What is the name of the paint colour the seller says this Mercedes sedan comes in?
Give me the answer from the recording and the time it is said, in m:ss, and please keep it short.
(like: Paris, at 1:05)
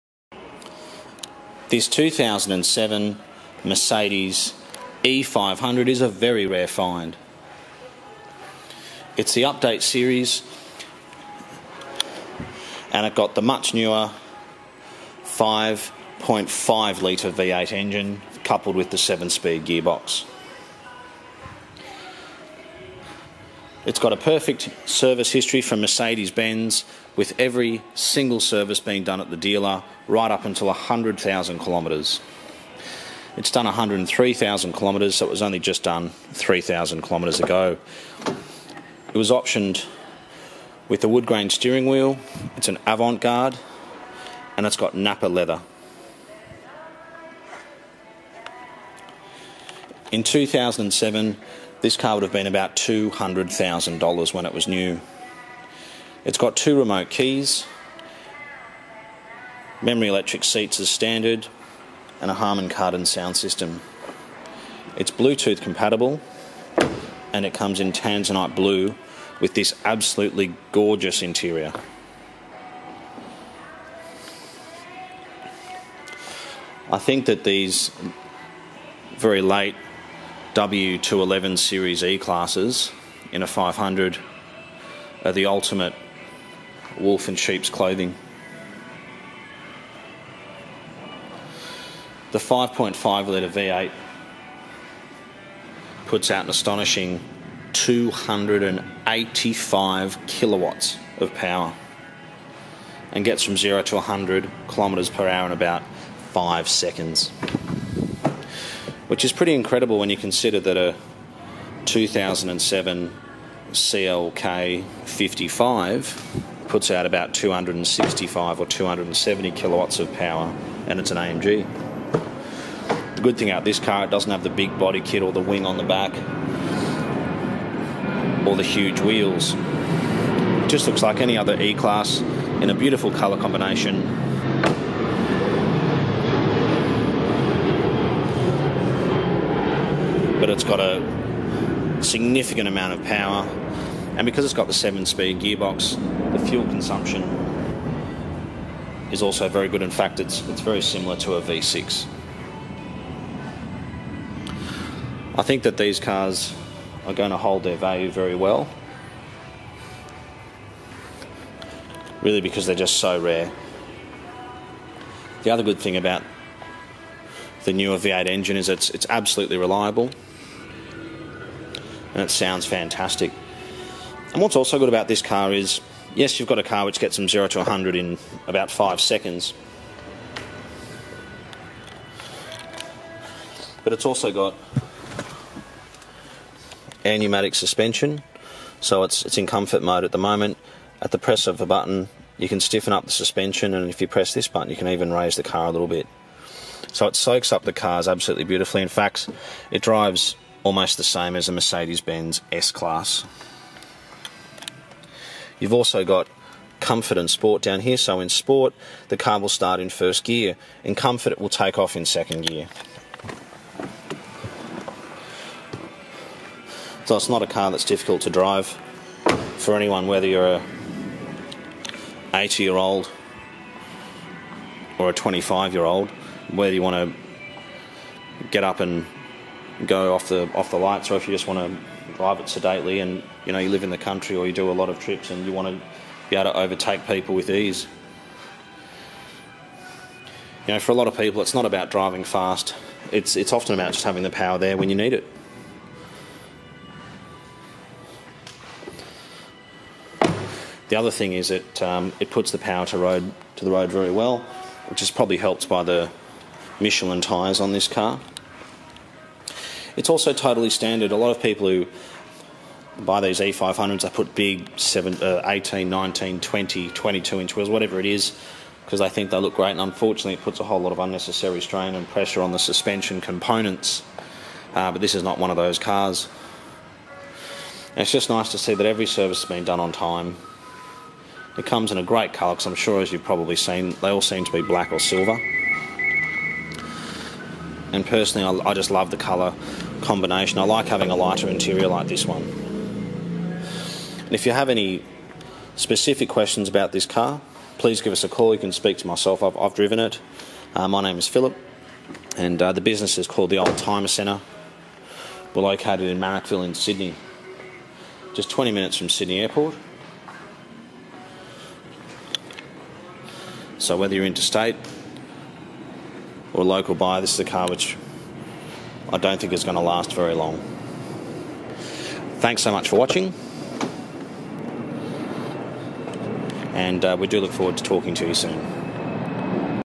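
Tanzanite blue, at 1:07.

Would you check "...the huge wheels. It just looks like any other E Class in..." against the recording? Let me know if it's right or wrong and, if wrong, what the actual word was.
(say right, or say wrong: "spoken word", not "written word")
right.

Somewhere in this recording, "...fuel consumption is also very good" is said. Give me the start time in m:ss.
2:26.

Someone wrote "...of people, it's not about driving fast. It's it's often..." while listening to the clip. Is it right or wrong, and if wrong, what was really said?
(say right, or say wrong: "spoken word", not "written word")
right.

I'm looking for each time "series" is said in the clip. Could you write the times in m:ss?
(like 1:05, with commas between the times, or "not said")
0:09, 1:21.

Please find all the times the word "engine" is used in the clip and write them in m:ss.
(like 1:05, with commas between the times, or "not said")
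0:17, 2:48.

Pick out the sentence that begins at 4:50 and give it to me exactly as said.
I like having a lighter interior like this one.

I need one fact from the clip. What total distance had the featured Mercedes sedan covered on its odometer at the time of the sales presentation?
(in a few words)
103,000 kilometres.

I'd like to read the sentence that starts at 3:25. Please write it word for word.
You've also got comfort and sport down here.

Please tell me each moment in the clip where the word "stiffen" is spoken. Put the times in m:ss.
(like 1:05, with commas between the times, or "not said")
3:12.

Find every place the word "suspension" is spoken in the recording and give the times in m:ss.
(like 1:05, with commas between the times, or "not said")
3:07, 3:13, 4:32.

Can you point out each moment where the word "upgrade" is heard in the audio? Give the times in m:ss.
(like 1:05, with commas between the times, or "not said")
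not said.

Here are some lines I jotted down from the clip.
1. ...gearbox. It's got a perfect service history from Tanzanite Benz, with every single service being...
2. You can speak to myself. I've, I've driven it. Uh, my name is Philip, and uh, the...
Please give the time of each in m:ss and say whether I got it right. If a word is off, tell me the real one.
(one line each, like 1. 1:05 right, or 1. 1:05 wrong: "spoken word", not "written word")
1. 0:19 wrong: "Mercedes", not "Tanzanite"
2. 4:58 right.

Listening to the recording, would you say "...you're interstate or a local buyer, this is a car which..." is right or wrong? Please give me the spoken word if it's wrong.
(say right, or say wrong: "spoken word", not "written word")
right.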